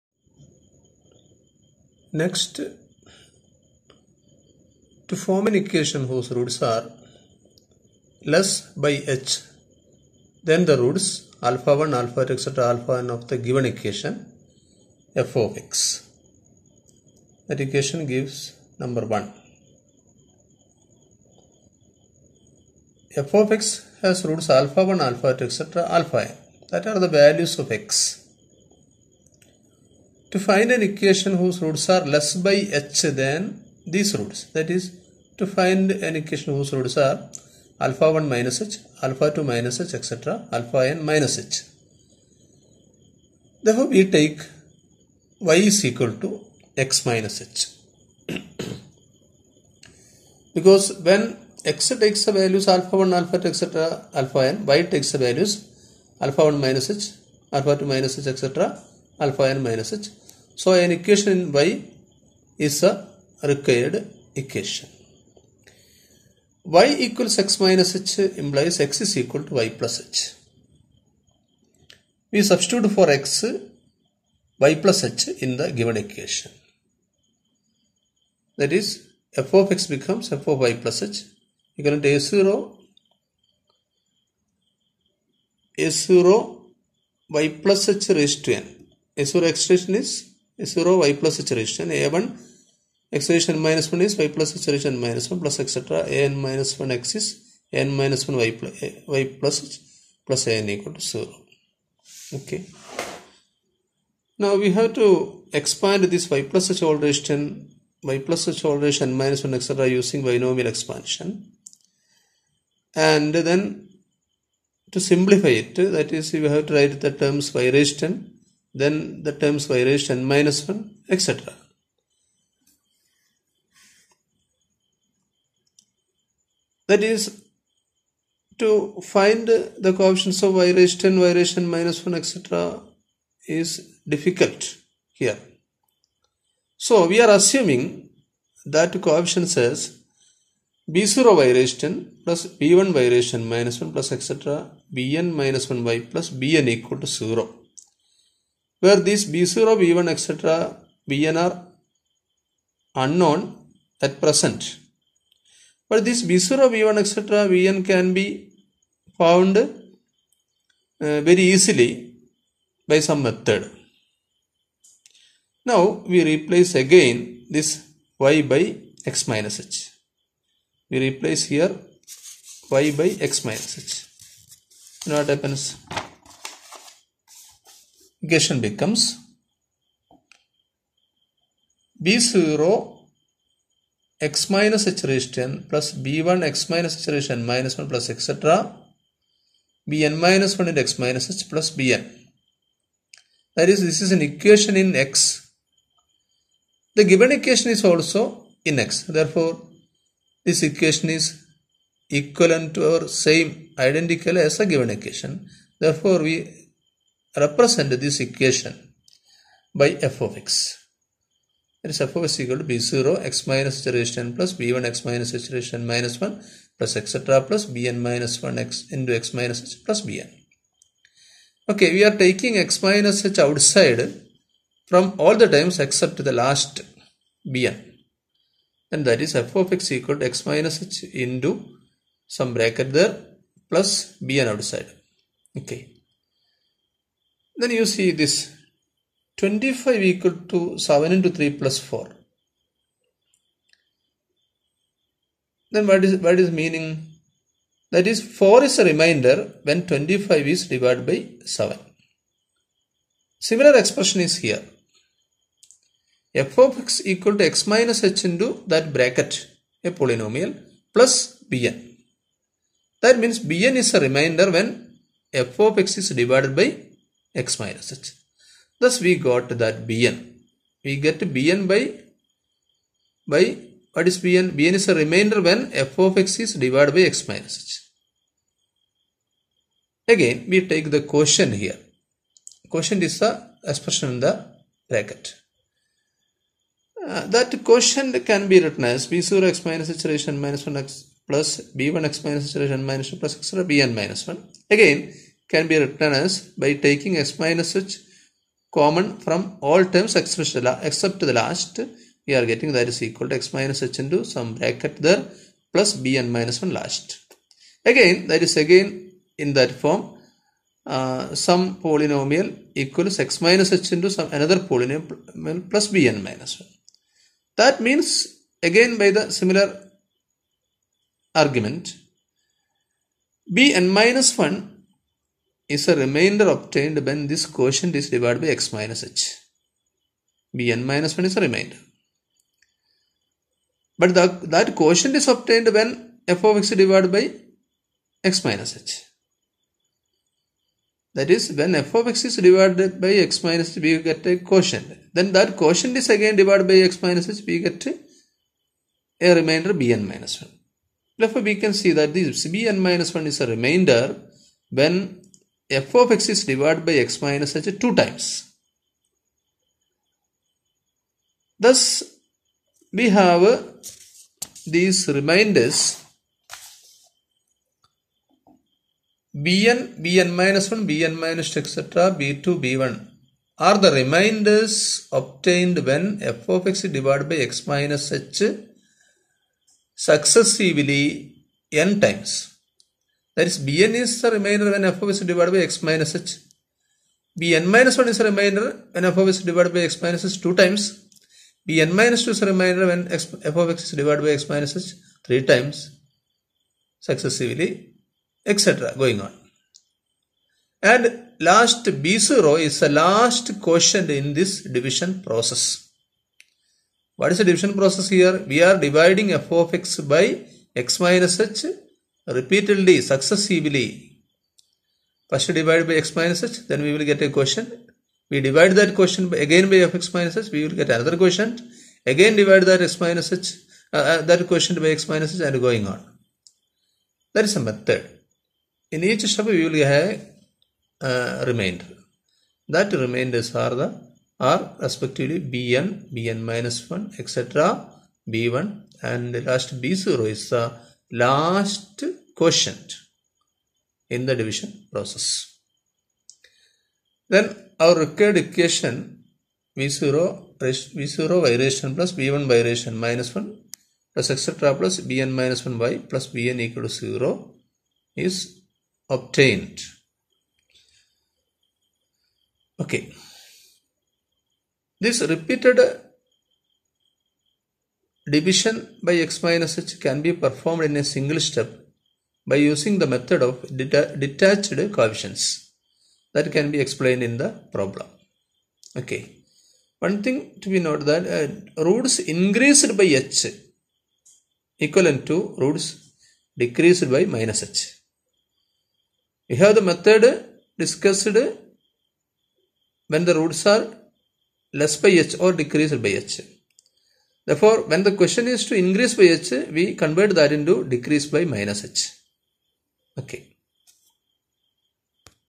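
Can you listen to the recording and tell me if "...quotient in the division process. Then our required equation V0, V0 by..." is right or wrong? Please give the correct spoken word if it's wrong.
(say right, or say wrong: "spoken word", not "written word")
right.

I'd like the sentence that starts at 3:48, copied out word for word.
And that is f of x equal to x minus h into some bracket there plus bn outside.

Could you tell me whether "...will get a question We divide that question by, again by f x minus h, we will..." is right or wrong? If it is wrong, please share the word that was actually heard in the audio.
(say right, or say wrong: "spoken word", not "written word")
right.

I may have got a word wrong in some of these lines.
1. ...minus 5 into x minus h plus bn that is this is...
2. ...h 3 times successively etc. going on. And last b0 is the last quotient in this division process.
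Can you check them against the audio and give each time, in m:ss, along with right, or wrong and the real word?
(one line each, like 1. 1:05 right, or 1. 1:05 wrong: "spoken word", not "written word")
1. 3:10 wrong: "1", not "5"
2. 6:34 right.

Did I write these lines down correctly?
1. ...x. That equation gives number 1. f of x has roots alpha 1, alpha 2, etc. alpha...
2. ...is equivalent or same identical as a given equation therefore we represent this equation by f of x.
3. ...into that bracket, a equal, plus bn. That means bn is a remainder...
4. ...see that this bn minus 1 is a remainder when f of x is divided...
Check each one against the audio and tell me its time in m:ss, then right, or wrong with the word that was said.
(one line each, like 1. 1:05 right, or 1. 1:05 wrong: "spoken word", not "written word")
1. 0:15 right
2. 3:21 right
3. 4:18 wrong: "polynomial", not "equal"
4. 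5:51 right.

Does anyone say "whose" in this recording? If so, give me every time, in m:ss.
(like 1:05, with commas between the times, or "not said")
0:06, 0:31, 0:36.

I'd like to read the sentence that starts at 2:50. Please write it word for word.
We replace here y by x minus h.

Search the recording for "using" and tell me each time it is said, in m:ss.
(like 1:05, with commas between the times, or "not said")
1:49, 7:52.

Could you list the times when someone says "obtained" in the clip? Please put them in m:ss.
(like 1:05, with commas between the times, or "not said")
5:26, 5:35, 6:15, 7:39.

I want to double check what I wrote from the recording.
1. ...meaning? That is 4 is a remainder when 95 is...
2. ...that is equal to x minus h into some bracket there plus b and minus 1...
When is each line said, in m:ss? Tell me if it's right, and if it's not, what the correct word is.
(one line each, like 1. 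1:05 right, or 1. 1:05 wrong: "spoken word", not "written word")
1. 4:06 wrong: "25", not "95"
2. 5:02 right.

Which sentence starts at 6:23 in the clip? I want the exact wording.
That is bn is the remainder when f of is divided by x minus h.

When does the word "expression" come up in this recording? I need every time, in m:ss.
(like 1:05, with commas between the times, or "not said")
4:13, 4:43.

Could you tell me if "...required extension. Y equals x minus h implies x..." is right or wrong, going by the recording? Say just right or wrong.
wrong.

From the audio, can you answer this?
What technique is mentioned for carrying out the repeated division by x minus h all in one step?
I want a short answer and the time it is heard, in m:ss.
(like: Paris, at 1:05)
method of detached coefficients, at 7:53.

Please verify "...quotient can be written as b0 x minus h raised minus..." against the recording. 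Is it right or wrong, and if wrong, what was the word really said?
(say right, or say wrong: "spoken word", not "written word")
right.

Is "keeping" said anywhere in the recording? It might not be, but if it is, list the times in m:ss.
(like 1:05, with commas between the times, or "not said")
not said.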